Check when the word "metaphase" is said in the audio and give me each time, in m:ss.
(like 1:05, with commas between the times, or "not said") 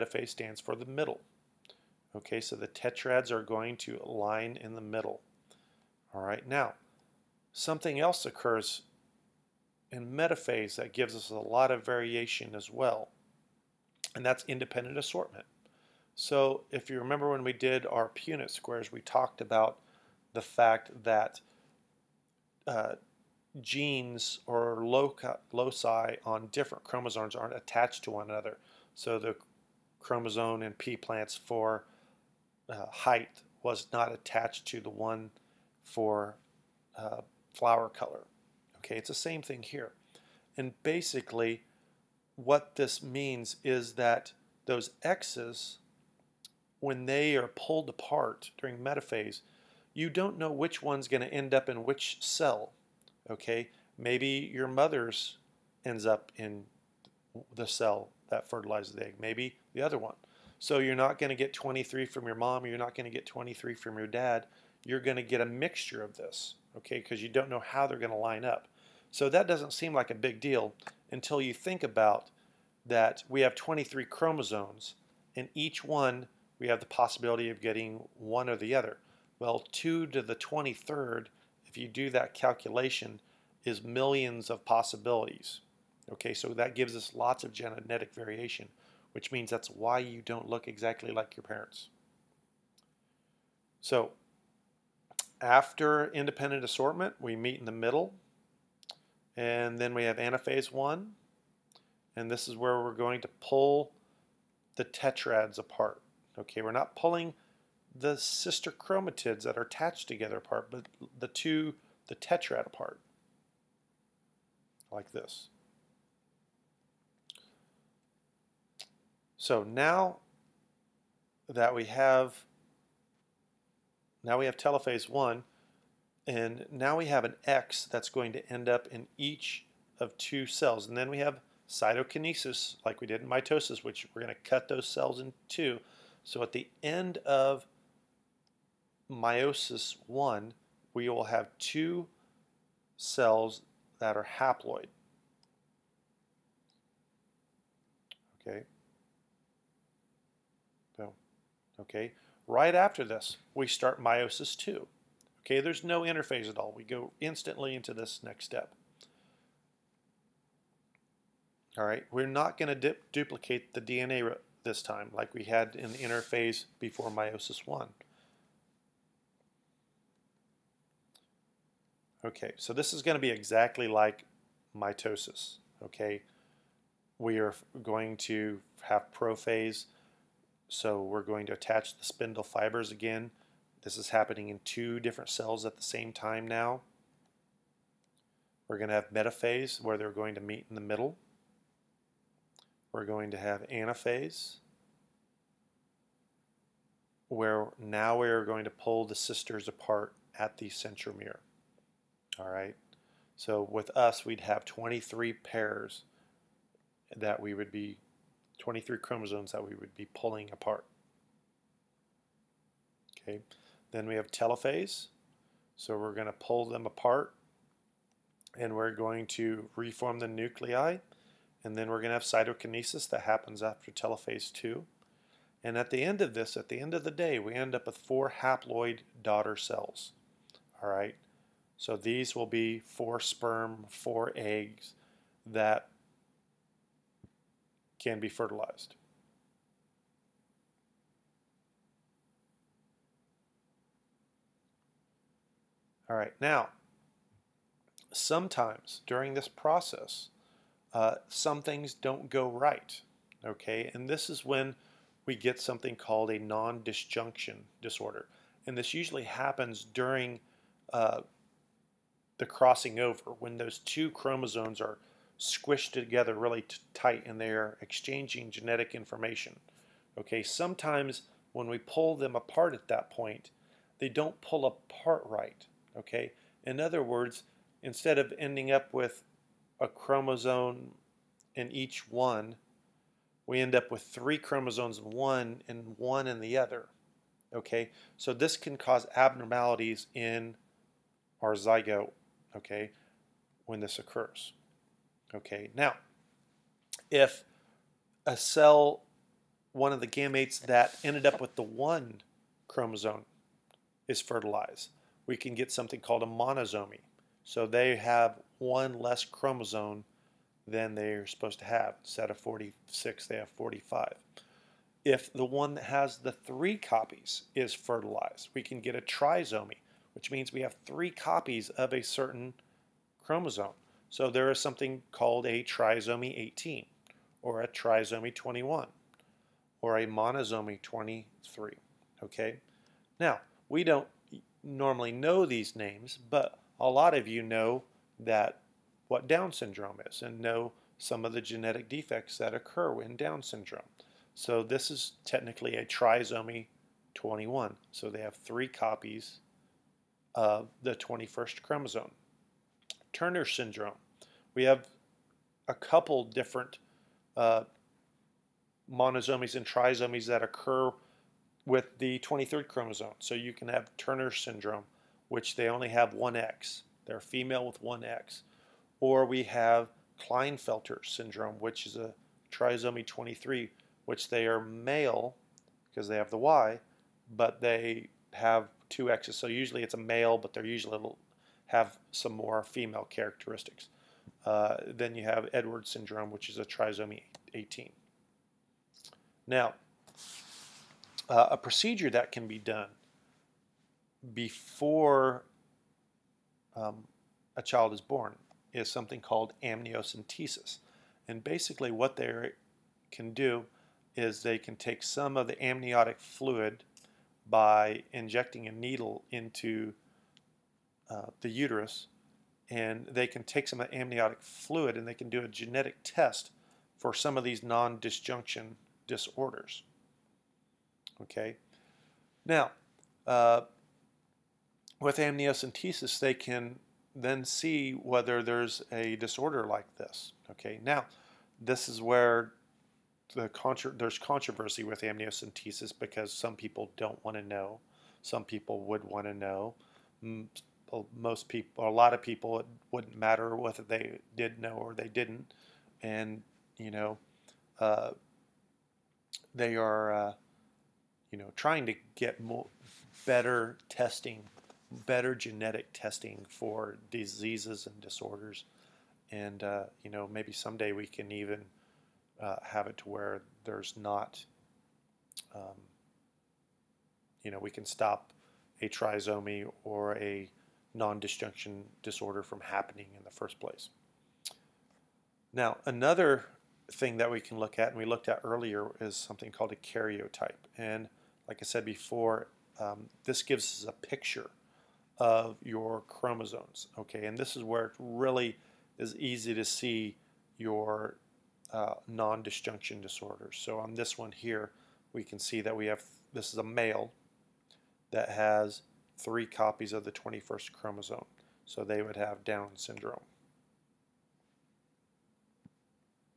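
0:10, 0:48, 3:09.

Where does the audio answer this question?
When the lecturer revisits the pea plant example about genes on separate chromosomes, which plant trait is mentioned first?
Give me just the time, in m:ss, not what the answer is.
0:32.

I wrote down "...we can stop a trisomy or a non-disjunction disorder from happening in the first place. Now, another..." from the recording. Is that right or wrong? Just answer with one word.
right.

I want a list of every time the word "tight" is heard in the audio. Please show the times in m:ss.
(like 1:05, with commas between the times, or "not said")
4:26.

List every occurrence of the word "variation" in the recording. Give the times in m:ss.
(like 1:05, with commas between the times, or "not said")
0:11, 1:28.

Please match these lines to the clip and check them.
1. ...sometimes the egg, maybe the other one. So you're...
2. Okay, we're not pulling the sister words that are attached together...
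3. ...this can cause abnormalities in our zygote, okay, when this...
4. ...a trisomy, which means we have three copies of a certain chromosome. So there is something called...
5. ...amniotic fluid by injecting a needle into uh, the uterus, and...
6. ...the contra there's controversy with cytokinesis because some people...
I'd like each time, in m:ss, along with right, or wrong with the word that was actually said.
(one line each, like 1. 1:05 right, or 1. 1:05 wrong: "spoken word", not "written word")
1. 0:58 wrong: "fertilizes", not "sometimes"
2. 1:46 wrong: "chromatids", not "words"
3. 4:48 right
4. 5:18 right
5. 6:45 right
6. 7:13 wrong: "amniocentesis", not "cytokinesis".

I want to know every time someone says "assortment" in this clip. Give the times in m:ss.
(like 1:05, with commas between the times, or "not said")
0:14, 1:36.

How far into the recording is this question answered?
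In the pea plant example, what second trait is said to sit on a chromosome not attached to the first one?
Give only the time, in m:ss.
0:37.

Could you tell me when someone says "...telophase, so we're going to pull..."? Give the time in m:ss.
3:34.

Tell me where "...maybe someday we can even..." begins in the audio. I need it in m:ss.
7:40.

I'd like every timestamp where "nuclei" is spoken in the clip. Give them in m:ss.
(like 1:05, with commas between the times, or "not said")
3:40.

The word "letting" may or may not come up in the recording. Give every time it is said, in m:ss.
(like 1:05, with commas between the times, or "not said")
not said.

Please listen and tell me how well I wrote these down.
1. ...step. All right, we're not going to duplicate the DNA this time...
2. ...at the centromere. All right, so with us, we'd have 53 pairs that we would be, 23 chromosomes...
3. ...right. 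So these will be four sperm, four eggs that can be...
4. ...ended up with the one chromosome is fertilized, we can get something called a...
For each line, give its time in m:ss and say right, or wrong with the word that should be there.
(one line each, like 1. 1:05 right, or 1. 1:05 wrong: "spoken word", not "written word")
1. 2:38 right
2. 3:20 wrong: "23", not "53"
3. 3:50 right
4. 5:01 right.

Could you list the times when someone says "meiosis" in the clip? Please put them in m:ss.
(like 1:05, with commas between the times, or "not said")
2:19, 2:34, 2:47.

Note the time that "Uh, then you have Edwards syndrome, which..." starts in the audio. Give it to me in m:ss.
6:24.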